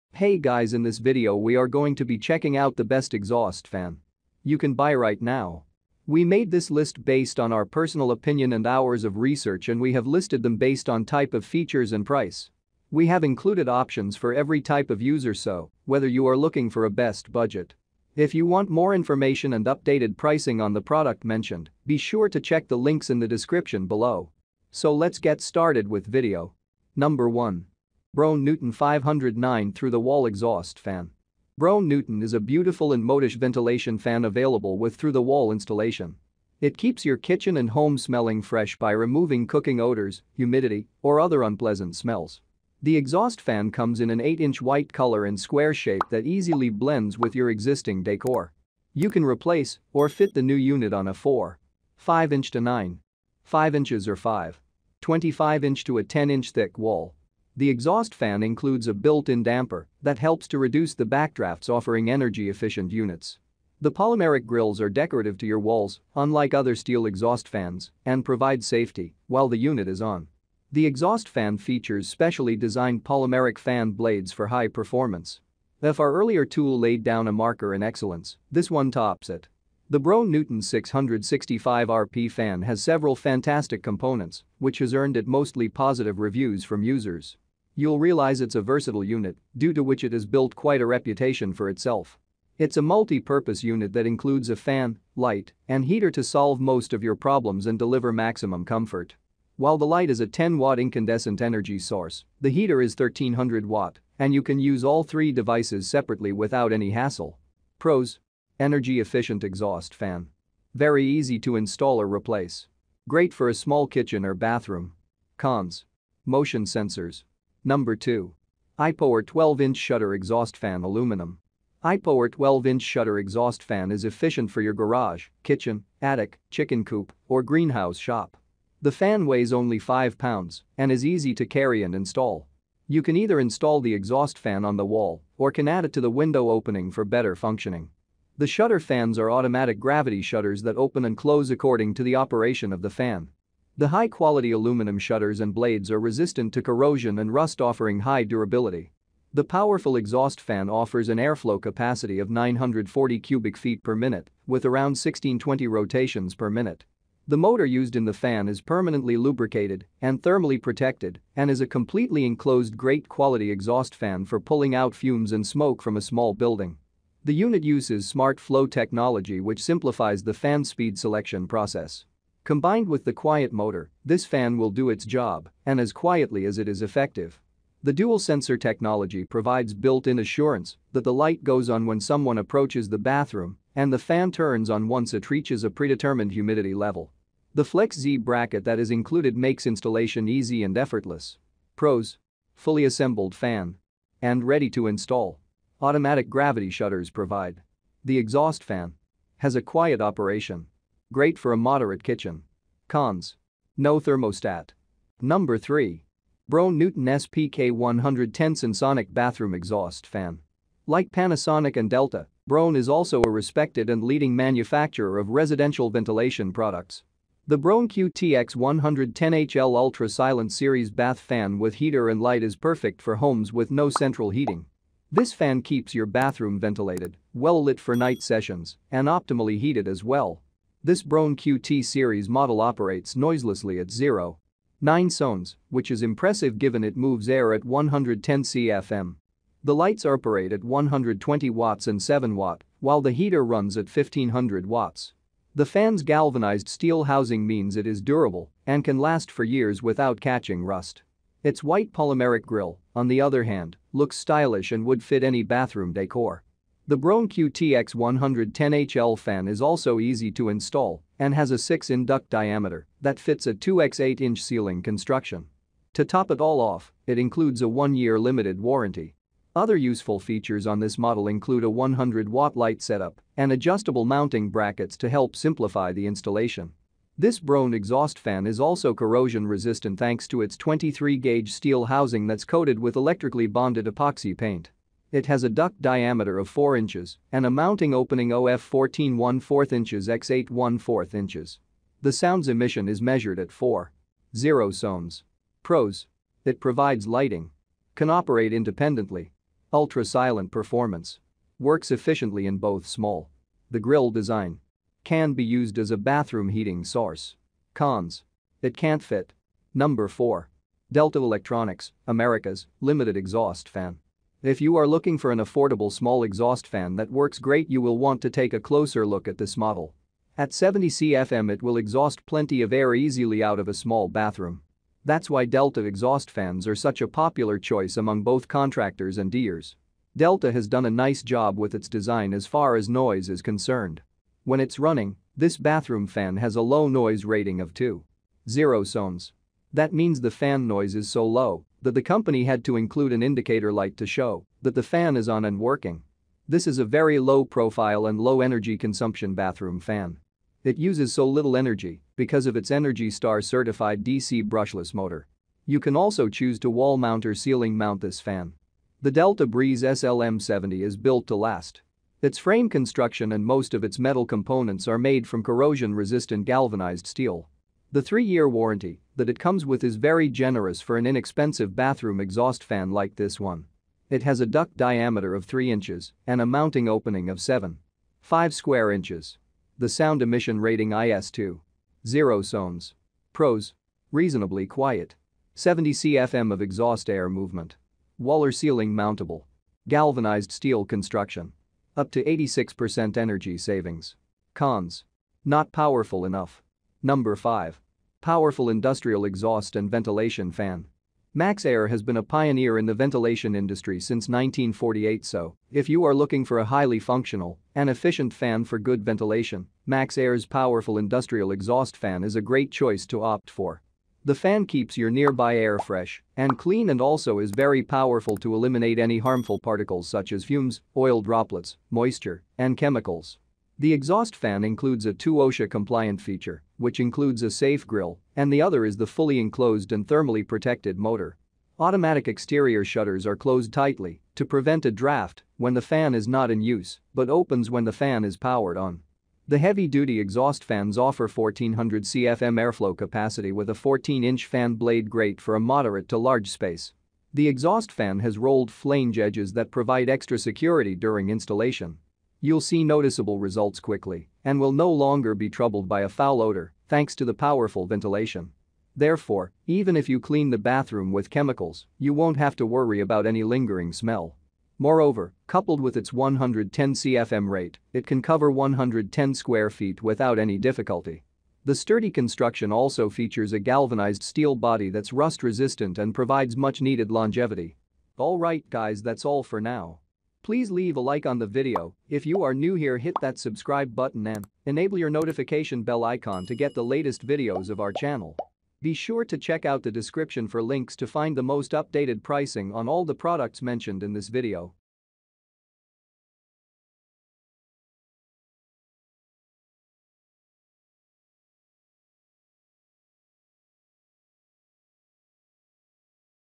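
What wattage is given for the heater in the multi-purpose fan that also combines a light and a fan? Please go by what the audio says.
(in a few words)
1300-watt.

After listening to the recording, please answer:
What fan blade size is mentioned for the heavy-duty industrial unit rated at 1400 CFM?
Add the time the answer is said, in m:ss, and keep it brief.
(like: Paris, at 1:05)
14-inch, at 7:23.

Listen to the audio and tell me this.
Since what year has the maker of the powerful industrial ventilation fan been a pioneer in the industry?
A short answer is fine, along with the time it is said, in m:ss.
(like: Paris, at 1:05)
1948, at 6:44.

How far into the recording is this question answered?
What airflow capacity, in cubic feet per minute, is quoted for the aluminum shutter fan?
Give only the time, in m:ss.
2:32.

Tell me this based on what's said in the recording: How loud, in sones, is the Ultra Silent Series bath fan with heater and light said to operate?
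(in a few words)
0.9 sones.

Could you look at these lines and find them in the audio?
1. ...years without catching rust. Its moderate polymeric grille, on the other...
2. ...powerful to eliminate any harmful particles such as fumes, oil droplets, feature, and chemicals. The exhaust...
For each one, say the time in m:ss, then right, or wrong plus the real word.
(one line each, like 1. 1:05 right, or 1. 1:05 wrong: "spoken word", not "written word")
1. 4:09 wrong: "white", not "moderate"
2. 6:57 wrong: "moisture", not "feature".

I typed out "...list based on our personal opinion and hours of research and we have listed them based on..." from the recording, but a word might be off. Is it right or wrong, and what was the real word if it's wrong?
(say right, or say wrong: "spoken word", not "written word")
right.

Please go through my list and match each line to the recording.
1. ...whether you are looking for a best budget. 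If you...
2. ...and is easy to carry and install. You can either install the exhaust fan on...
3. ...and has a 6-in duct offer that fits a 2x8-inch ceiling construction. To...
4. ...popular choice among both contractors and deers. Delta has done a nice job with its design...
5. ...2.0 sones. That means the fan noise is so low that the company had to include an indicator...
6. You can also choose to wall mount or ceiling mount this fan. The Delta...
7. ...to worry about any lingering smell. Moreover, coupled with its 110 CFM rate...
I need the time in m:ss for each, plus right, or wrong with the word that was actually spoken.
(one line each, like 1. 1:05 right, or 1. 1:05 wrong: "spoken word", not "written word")
1. 0:15 right
2. 2:10 right
3. 4:21 wrong: "diameter", not "offer"
4. 5:27 right
5. 5:37 right
6. 5:55 right
7. 7:42 right.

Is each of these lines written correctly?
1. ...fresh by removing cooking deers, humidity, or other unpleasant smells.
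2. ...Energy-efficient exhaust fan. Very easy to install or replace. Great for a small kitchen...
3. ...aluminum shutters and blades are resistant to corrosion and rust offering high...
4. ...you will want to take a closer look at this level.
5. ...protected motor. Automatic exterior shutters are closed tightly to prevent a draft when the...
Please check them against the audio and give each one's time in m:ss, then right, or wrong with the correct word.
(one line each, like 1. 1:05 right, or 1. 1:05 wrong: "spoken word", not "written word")
1. 0:38 wrong: "odors", not "deers"
2. 1:48 right
3. 2:24 right
4. 5:17 wrong: "model", not "level"
5. 7:10 right.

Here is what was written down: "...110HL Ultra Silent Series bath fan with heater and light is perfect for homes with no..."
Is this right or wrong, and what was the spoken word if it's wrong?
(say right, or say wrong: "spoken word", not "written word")
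right.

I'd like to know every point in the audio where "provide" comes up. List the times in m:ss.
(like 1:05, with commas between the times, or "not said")
1:08, 2:59, 3:17, 4:56, 7:29, 7:56.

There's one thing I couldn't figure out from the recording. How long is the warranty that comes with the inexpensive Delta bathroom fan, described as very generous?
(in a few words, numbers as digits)
3 years.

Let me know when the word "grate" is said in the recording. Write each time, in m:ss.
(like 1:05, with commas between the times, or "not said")
7:25.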